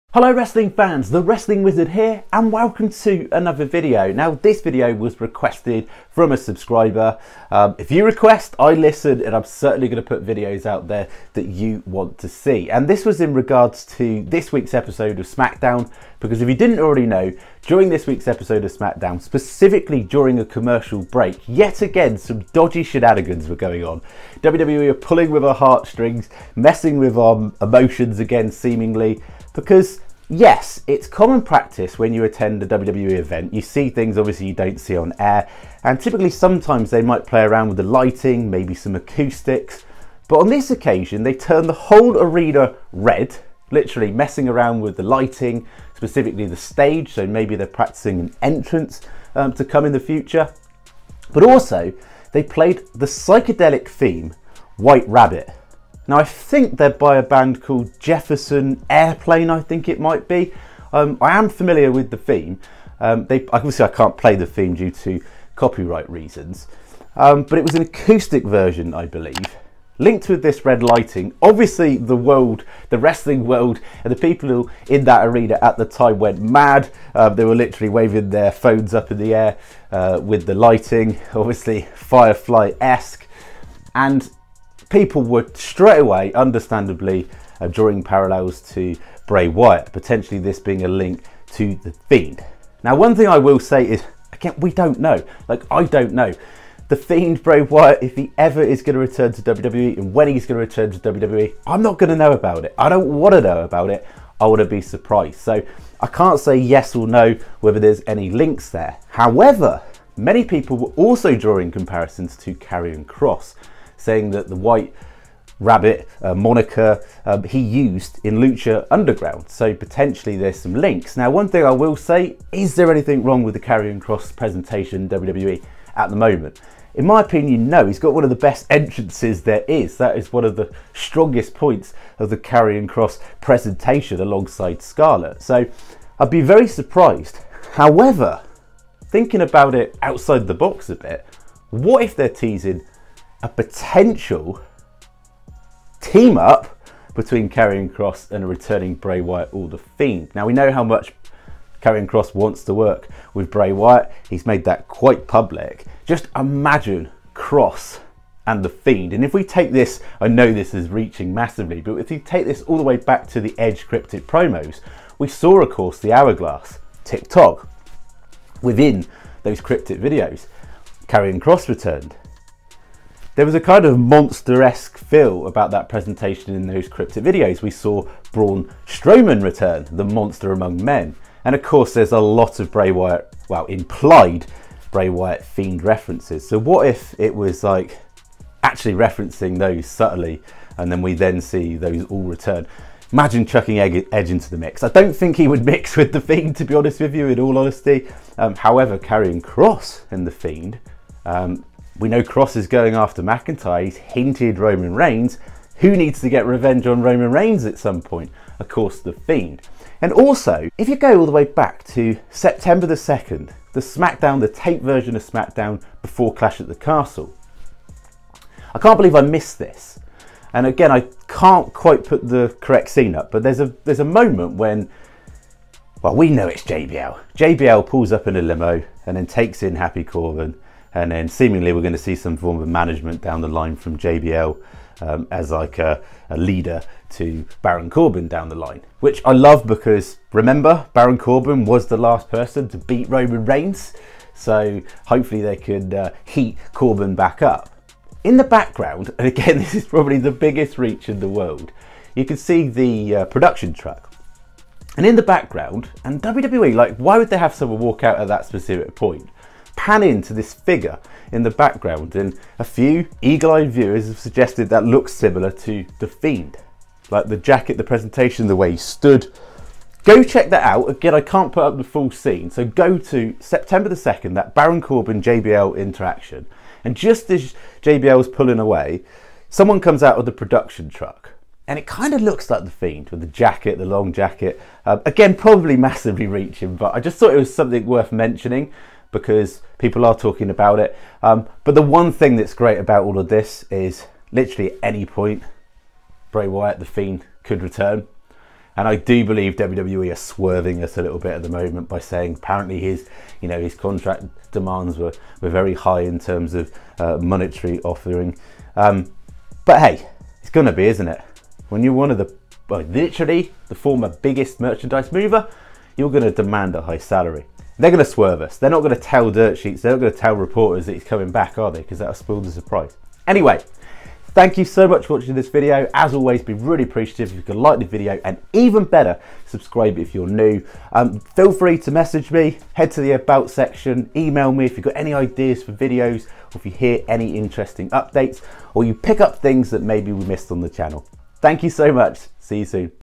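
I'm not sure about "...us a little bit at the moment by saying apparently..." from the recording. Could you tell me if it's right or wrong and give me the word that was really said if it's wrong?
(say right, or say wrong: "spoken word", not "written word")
right.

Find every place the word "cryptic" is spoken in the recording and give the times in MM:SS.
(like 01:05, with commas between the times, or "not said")
02:43, 02:49, 02:56.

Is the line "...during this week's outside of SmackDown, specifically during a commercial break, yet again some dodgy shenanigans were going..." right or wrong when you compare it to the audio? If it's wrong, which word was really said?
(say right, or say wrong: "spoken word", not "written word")
wrong: "episode", not "outside".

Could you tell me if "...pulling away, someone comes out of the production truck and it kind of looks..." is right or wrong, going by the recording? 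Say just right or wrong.
right.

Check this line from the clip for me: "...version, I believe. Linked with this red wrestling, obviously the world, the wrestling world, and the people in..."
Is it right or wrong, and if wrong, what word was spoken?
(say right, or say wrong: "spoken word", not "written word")
wrong: "lighting", not "wrestling".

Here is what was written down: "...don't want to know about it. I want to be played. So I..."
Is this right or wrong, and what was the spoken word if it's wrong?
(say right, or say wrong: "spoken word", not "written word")
wrong: "surprised", not "played".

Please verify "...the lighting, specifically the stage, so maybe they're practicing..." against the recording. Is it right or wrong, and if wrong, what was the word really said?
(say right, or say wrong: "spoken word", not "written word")
right.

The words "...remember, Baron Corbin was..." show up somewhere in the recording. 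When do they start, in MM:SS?
04:00.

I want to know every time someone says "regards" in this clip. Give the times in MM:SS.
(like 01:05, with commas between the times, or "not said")
00:13.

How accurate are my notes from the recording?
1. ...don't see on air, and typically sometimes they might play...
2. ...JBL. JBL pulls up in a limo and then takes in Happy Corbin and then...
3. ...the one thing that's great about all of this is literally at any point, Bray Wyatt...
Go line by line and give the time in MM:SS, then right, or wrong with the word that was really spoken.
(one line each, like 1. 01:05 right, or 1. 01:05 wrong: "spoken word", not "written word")
1. 00:34 right
2. 03:46 right
3. 04:51 right.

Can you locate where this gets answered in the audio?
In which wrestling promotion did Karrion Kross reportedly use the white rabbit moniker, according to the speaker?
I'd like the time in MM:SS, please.
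01:58.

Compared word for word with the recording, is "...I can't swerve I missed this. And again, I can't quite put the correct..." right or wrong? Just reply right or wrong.
wrong.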